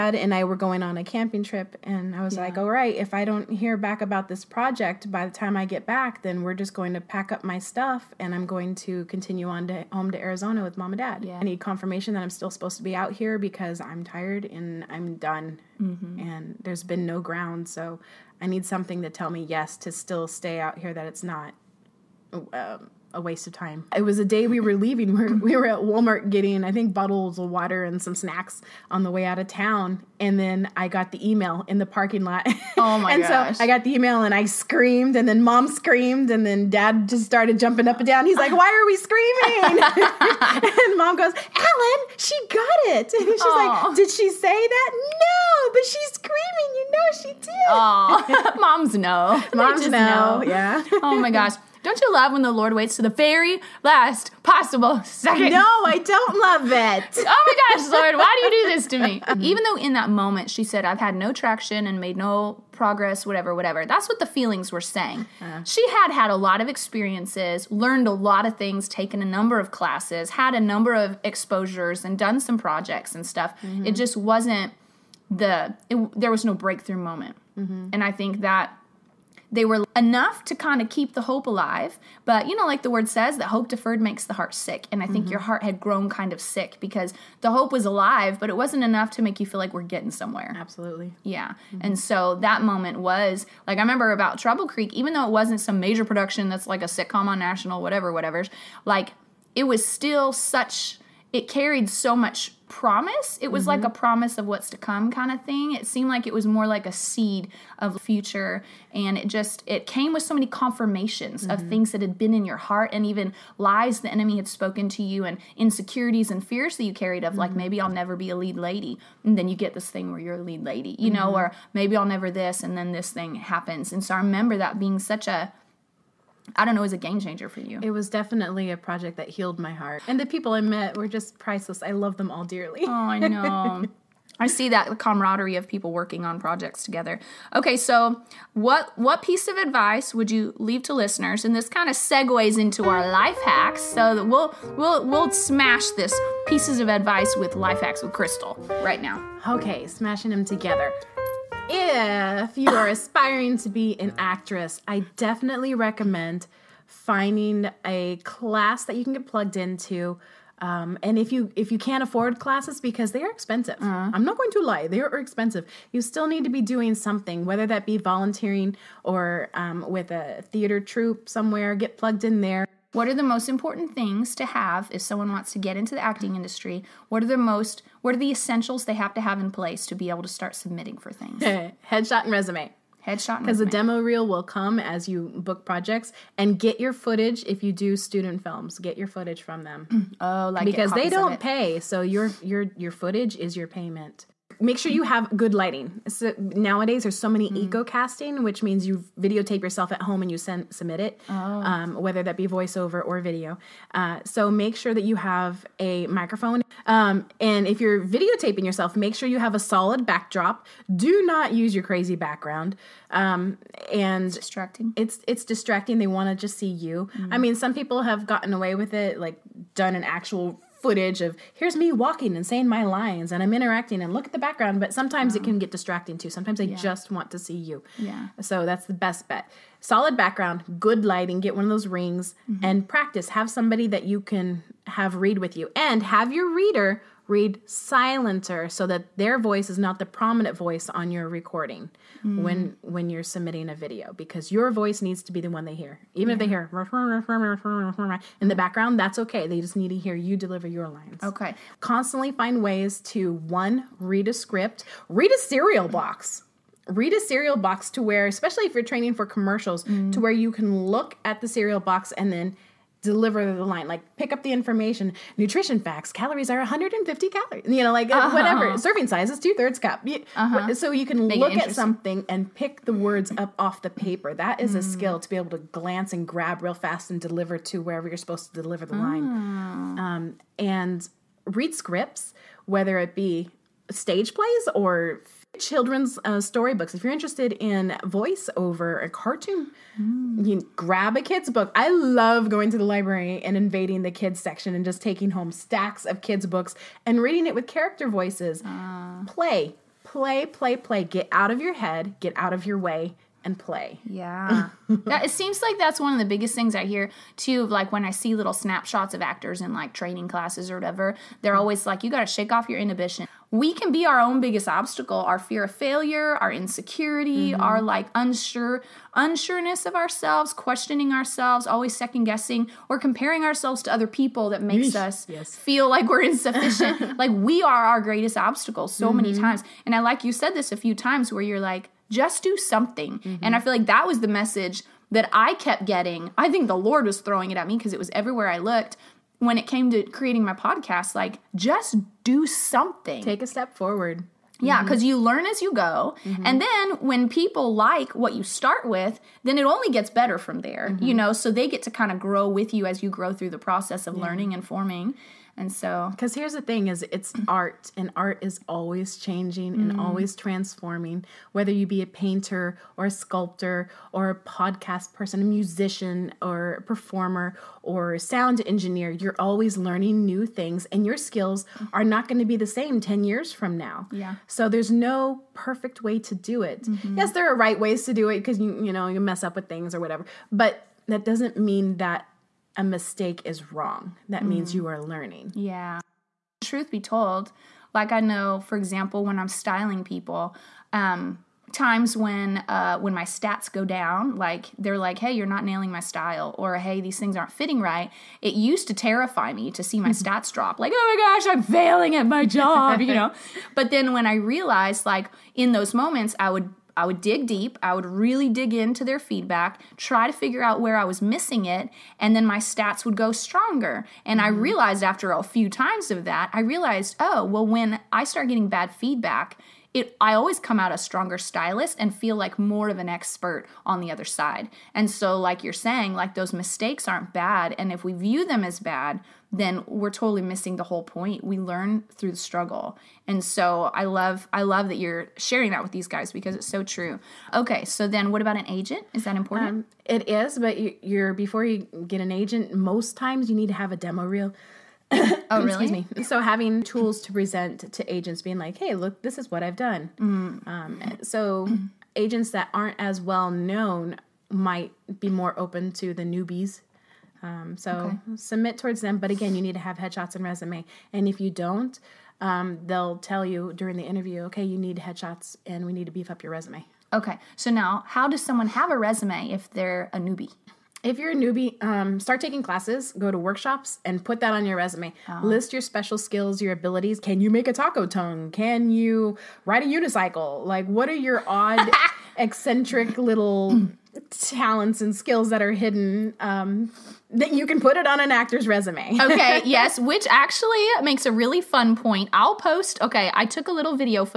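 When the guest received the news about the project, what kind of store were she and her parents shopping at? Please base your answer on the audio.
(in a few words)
Walmart.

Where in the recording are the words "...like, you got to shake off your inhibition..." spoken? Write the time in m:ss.
5:11.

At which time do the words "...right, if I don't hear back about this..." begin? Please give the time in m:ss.
0:02.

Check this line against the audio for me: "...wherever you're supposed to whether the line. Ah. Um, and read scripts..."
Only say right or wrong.
wrong.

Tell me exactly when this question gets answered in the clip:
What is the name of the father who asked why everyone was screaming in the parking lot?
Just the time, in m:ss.
0:41.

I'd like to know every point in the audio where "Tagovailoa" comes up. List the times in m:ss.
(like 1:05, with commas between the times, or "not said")
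not said.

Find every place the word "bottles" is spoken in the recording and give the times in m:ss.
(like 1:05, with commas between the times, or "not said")
0:26.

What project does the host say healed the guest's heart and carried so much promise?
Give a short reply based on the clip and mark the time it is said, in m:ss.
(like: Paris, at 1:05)
Trouble Creek, at 1:34.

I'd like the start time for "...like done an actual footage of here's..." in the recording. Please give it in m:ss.
3:39.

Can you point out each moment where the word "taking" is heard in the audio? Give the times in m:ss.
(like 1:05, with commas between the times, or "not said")
4:55, 7:52.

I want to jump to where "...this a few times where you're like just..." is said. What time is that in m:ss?
5:30.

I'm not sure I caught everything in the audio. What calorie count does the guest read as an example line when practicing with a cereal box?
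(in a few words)
150 calories.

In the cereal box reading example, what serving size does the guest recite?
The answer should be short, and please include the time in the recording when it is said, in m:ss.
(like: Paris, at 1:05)
Two thirds cup, at 4:29.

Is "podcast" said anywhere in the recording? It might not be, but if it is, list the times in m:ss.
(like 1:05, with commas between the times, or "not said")
5:40, 6:04.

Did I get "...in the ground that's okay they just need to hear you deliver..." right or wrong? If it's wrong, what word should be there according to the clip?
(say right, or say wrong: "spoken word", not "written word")
wrong: "background", not "ground".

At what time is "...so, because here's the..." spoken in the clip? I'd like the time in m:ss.
5:55.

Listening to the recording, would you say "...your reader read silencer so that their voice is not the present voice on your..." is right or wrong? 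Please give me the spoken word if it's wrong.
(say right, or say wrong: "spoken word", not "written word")
wrong: "prominent", not "present".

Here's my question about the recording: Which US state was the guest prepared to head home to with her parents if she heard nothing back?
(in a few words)
Arizona.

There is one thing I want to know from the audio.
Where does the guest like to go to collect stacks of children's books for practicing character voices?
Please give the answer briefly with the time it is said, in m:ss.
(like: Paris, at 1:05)
The library, at 4:52.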